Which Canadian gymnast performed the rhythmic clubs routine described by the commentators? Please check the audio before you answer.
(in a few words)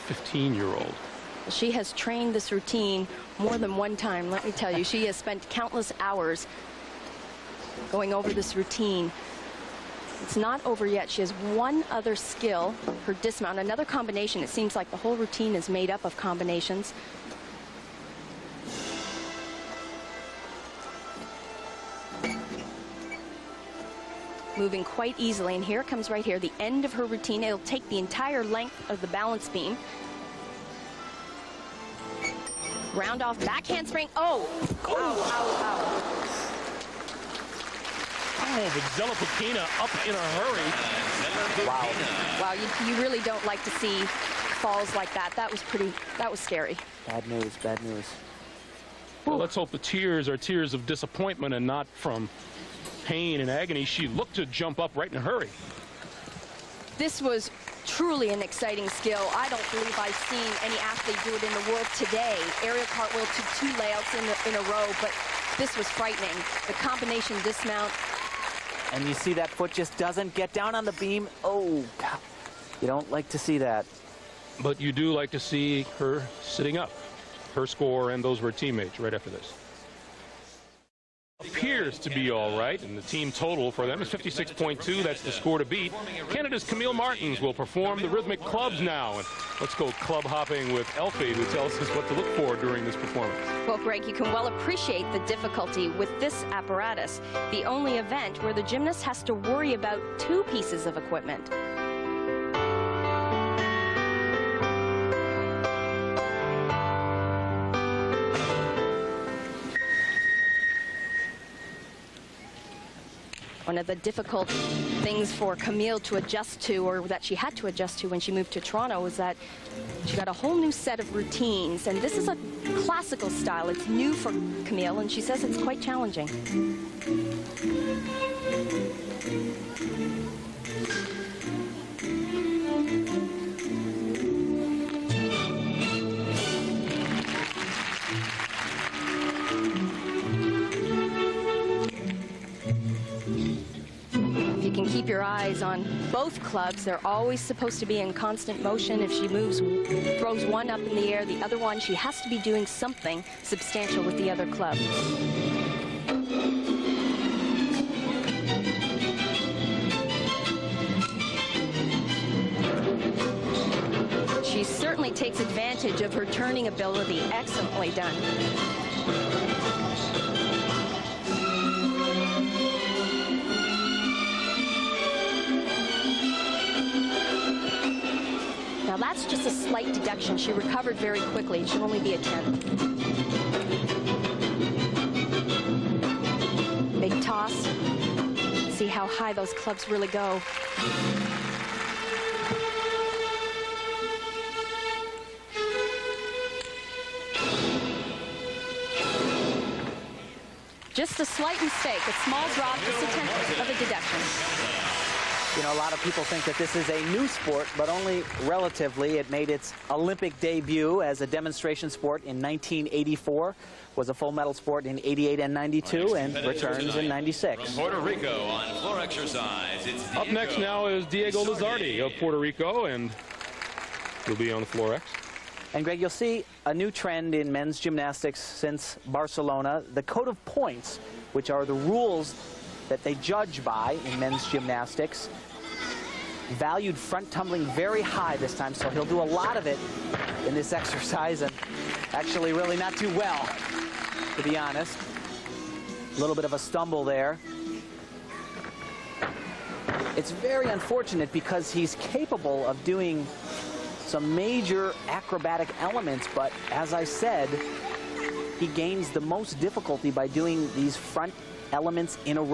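Camille Martens.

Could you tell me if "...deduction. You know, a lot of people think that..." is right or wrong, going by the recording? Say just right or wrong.
right.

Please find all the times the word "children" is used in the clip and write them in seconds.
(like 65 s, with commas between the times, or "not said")
not said.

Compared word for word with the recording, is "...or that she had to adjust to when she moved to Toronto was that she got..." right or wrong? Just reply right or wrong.
right.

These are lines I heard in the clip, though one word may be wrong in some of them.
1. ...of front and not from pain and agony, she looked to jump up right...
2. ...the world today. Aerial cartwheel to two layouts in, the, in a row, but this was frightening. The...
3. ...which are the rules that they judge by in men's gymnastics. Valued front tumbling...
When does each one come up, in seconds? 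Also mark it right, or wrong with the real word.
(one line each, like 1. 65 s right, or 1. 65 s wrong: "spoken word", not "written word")
1. 50 s wrong: "disappointment", not "front"
2. 61 s right
3. 231 s right.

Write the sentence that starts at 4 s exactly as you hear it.
She has spent countless hours going over this routine.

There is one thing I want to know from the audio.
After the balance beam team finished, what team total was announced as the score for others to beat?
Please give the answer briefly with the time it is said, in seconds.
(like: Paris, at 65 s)
56.2, at 84 s.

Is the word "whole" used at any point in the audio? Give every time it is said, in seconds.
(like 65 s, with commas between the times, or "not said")
14 s, 120 s.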